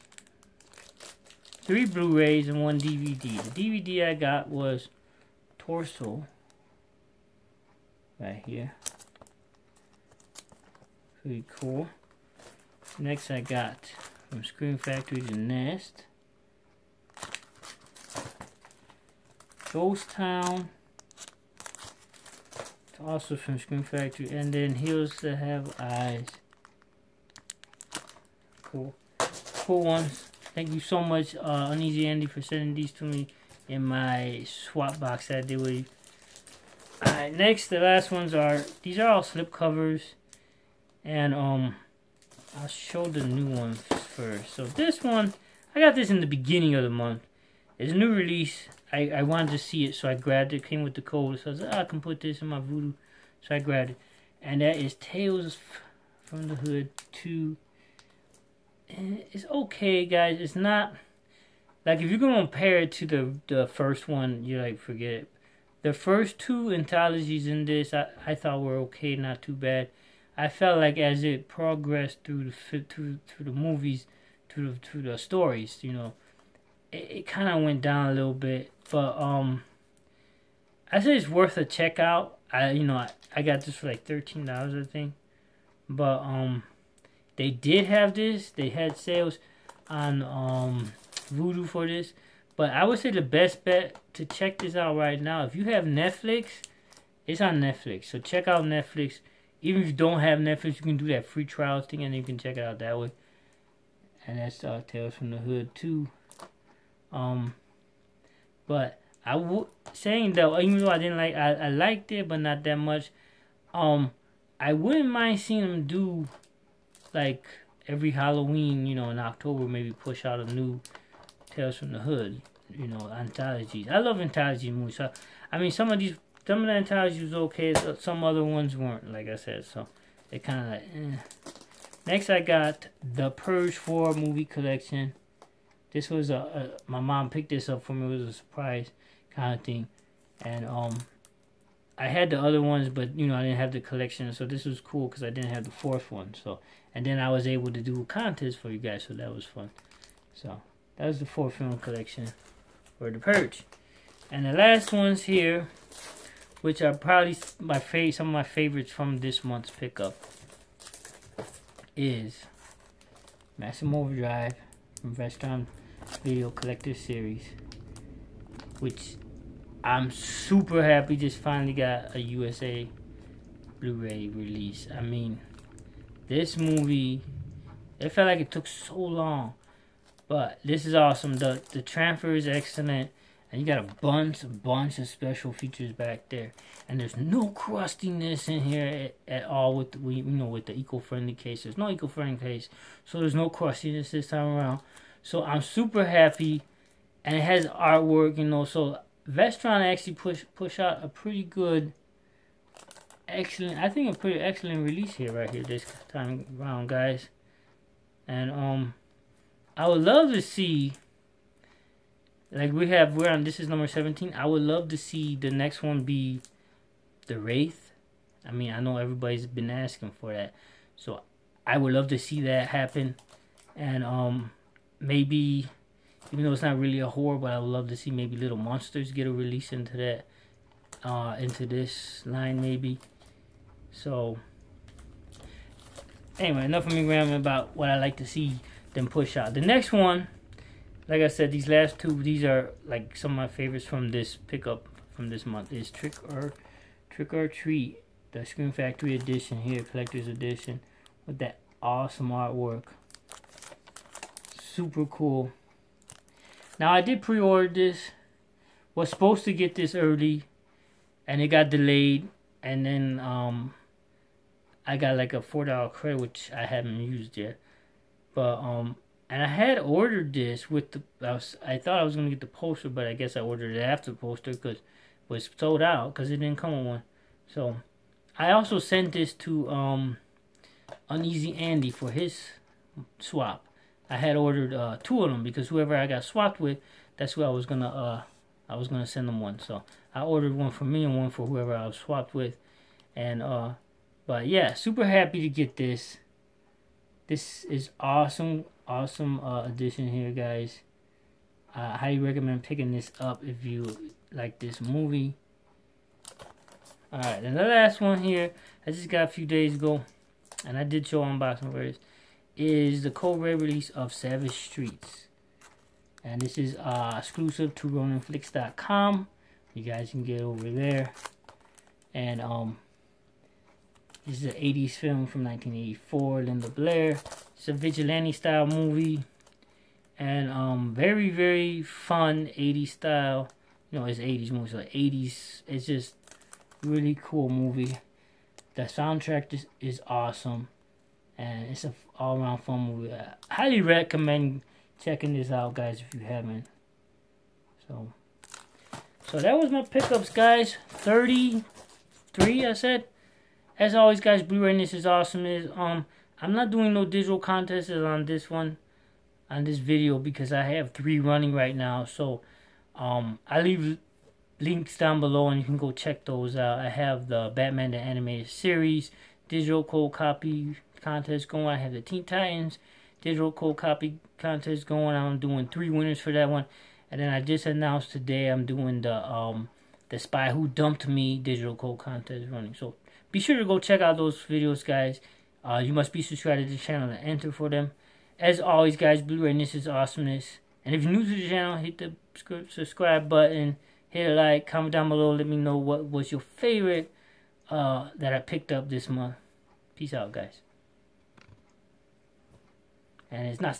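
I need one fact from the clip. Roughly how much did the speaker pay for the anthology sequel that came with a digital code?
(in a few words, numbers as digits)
$13.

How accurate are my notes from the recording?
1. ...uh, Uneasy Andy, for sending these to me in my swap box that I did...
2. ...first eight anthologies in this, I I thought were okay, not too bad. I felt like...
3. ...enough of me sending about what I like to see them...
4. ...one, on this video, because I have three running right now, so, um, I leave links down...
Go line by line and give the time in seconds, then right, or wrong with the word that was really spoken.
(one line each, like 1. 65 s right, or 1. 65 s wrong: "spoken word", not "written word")
1. 31 s right
2. 65 s wrong: "two", not "eight"
3. 236 s wrong: "rambling", not "sending"
4. 358 s right.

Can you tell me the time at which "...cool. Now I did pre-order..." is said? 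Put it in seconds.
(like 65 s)
255 s.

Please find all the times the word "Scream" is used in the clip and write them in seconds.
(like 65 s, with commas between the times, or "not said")
14 s, 23 s, 248 s.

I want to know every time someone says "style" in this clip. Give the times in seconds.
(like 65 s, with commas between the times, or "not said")
328 s, 332 s.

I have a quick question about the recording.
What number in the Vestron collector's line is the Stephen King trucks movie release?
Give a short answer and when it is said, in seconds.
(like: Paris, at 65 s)
17, at 213 s.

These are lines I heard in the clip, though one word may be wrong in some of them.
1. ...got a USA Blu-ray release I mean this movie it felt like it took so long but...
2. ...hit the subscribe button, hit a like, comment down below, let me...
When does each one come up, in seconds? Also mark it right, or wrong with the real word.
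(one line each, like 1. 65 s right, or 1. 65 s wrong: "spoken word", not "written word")
1. 171 s right
2. 391 s right.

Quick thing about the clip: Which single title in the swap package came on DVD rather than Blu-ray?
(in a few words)
Torso.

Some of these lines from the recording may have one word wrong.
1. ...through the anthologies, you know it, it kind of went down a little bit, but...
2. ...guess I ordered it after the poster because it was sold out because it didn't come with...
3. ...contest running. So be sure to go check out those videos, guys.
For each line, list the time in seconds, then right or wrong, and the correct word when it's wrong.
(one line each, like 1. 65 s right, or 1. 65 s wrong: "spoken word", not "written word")
1. 74 s wrong: "stories", not "anthologies"
2. 273 s right
3. 381 s right.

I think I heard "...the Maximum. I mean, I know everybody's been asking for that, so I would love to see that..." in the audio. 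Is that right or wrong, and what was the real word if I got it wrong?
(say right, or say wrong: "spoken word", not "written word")
wrong: "Wraith", not "Maximum".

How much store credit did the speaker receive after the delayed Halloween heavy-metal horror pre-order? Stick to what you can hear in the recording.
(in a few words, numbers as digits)
$4.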